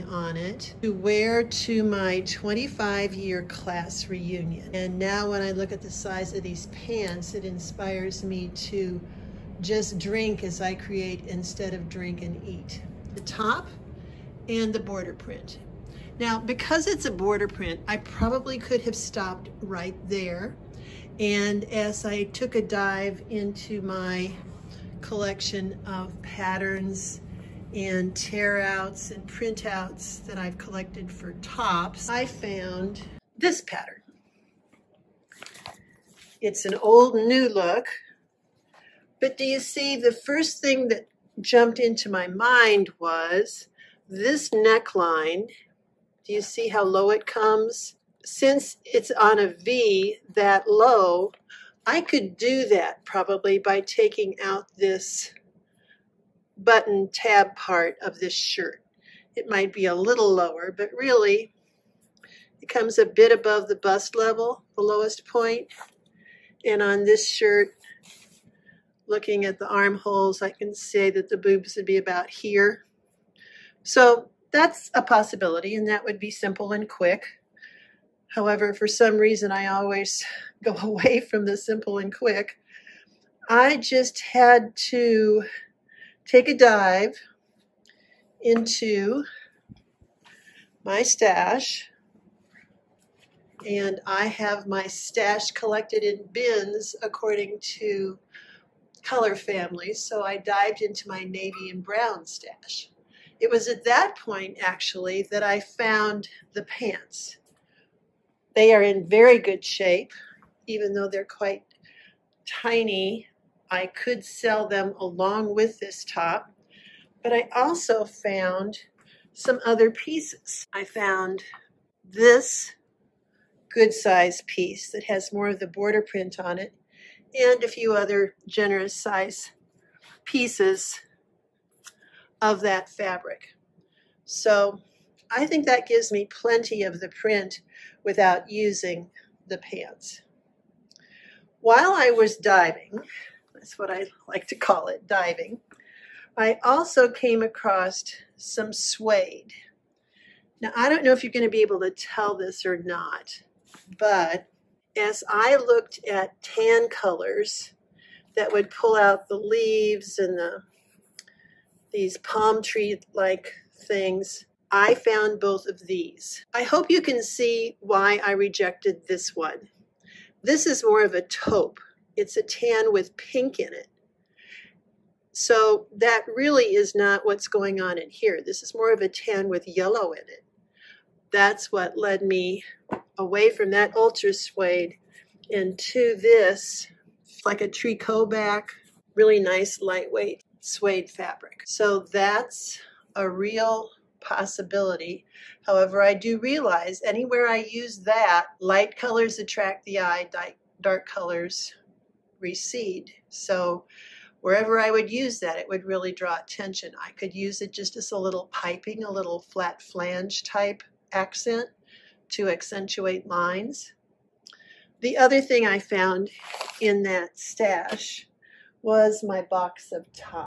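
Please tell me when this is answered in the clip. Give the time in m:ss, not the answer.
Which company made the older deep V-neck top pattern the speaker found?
0:37.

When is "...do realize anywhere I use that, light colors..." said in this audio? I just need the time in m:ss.
3:16.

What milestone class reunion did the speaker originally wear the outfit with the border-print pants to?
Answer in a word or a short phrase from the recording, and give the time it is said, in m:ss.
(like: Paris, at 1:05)
25 year, at 0:02.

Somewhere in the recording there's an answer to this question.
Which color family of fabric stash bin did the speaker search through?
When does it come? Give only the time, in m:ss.
1:41.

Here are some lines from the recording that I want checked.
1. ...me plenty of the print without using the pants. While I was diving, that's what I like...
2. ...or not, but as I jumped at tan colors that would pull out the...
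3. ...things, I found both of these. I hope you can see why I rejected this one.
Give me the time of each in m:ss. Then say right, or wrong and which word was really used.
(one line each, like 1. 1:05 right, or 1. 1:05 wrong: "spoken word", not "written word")
1. 2:16 right
2. 2:32 wrong: "looked", not "jumped"
3. 2:43 right.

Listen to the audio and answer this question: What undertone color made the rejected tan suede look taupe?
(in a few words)
pink.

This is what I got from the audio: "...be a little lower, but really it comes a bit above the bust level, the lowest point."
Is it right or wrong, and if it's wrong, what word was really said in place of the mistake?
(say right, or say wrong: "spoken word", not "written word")
right.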